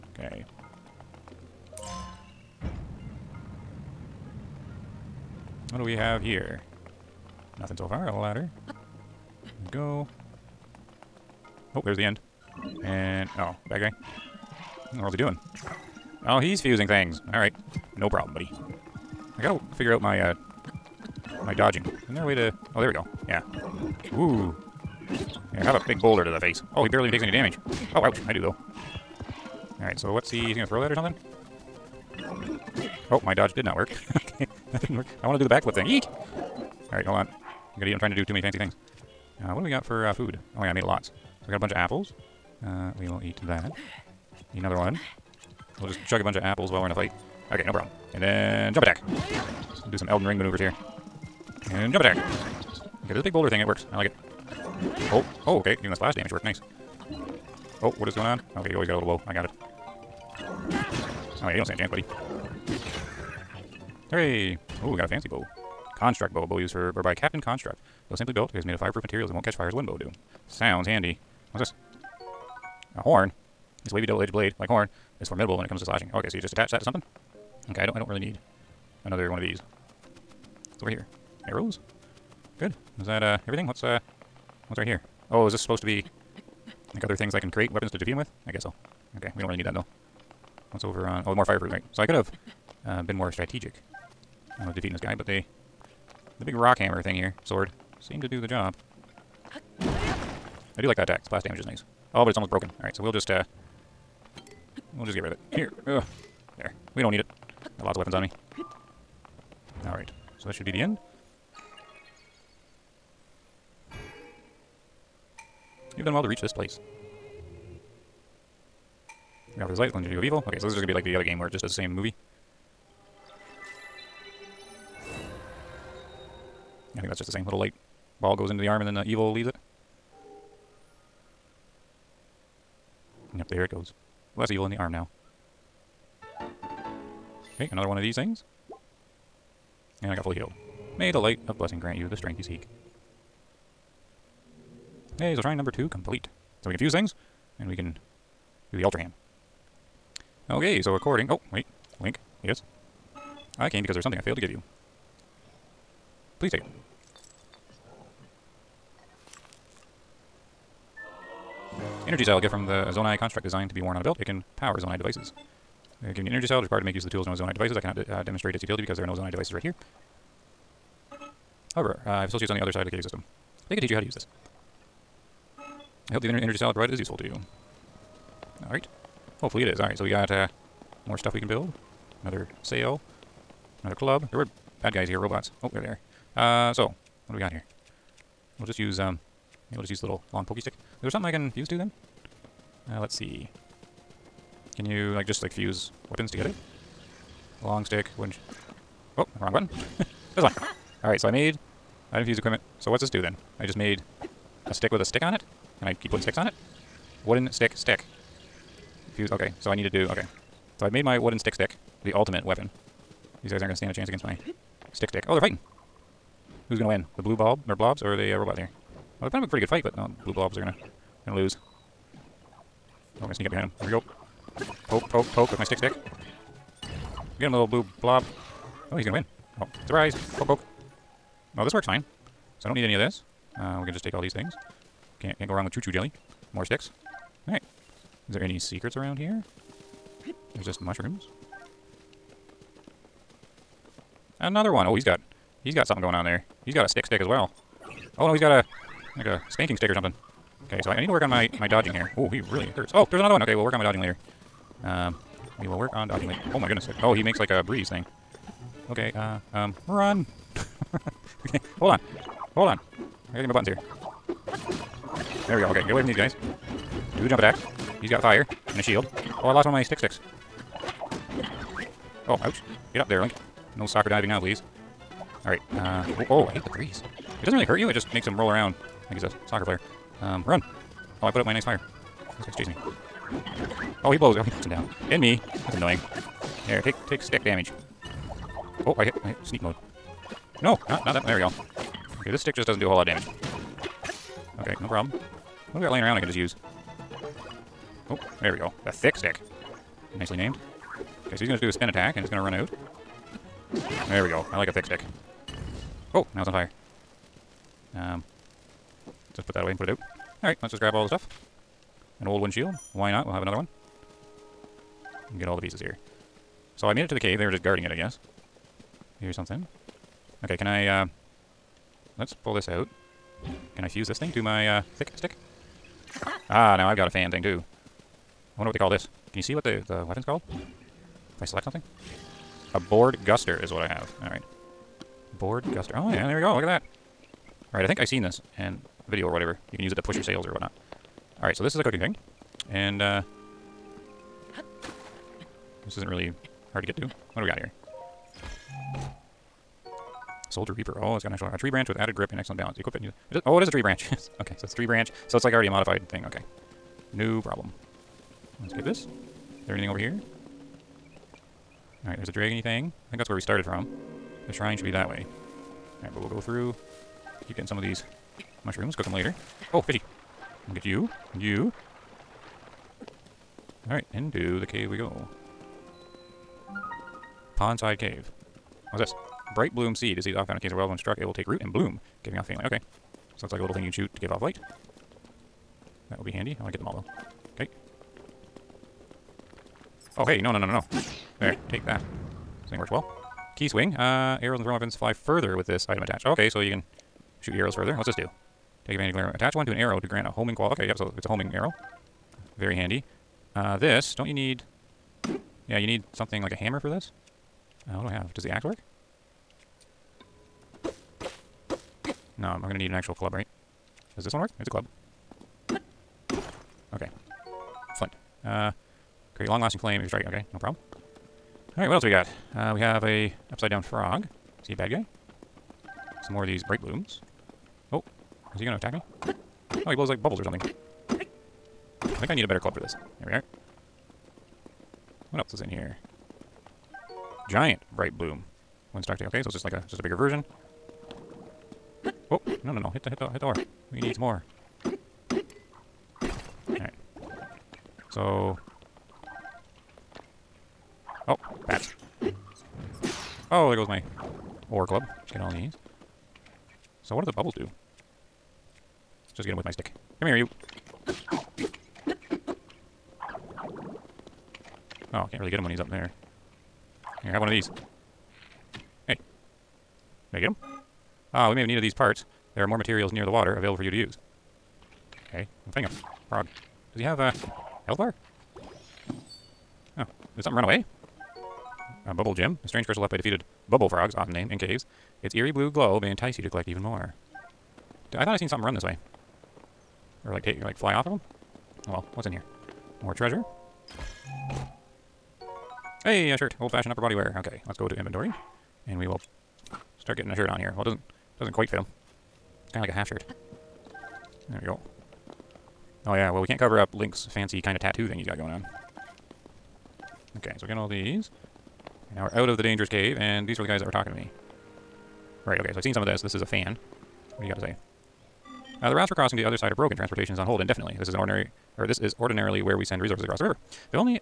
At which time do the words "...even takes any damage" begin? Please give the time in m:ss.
0:27.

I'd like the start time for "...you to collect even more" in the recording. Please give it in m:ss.
8:06.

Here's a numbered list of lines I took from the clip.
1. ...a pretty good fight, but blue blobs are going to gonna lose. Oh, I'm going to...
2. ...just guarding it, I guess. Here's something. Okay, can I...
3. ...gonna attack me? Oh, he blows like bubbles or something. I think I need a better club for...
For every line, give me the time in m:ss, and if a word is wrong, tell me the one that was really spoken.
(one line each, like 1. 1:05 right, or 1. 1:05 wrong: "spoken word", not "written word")
1. 3:39 right
2. 5:17 right
3. 7:08 right.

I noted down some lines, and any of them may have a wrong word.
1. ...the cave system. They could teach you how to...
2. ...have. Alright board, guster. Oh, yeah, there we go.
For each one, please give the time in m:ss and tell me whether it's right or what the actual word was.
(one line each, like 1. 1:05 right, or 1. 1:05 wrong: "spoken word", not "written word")
1. 2:52 right
2. 5:33 right.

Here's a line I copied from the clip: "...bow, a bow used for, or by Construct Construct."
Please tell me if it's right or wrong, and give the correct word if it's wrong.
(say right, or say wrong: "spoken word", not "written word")
wrong: "Captain", not "Construct".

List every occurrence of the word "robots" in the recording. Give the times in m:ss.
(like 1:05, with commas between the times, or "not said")
3:05, 3:38.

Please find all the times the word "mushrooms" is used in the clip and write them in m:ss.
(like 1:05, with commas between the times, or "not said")
4:00, 6:08.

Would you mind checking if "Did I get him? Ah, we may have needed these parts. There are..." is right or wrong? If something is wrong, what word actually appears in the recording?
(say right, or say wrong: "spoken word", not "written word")
right.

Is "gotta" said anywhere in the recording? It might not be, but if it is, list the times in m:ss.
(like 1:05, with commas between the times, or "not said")
0:19, 0:37, 4:23.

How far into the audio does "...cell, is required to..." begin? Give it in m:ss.
2:46.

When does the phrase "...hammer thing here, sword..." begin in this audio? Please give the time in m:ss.
1:36.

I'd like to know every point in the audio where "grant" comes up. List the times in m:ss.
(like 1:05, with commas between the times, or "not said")
2:21, 6:40.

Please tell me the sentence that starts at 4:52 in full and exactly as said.
Okay, this stick just doesn't do a whole lot of damage.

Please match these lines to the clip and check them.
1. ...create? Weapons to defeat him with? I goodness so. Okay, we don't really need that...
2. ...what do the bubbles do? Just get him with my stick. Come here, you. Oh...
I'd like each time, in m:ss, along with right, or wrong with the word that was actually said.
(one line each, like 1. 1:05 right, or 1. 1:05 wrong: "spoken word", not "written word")
1. 1:27 wrong: "guess", not "goodness"
2. 7:37 right.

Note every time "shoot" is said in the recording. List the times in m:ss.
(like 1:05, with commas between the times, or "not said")
6:23, 6:37.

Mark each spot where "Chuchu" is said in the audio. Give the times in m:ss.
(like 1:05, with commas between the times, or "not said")
3:55.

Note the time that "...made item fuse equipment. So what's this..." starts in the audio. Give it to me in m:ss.
3:21.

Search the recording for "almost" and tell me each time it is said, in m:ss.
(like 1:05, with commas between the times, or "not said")
1:42.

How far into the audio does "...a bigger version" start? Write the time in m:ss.
7:19.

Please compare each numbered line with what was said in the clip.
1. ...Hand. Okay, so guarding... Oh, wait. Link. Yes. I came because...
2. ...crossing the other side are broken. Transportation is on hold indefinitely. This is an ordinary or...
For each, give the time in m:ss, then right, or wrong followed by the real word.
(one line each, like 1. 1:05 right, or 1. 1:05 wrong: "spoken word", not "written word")
1. 2:28 wrong: "according", not "guarding"
2. 8:39 right.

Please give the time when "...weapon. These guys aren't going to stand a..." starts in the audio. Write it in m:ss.
3:32.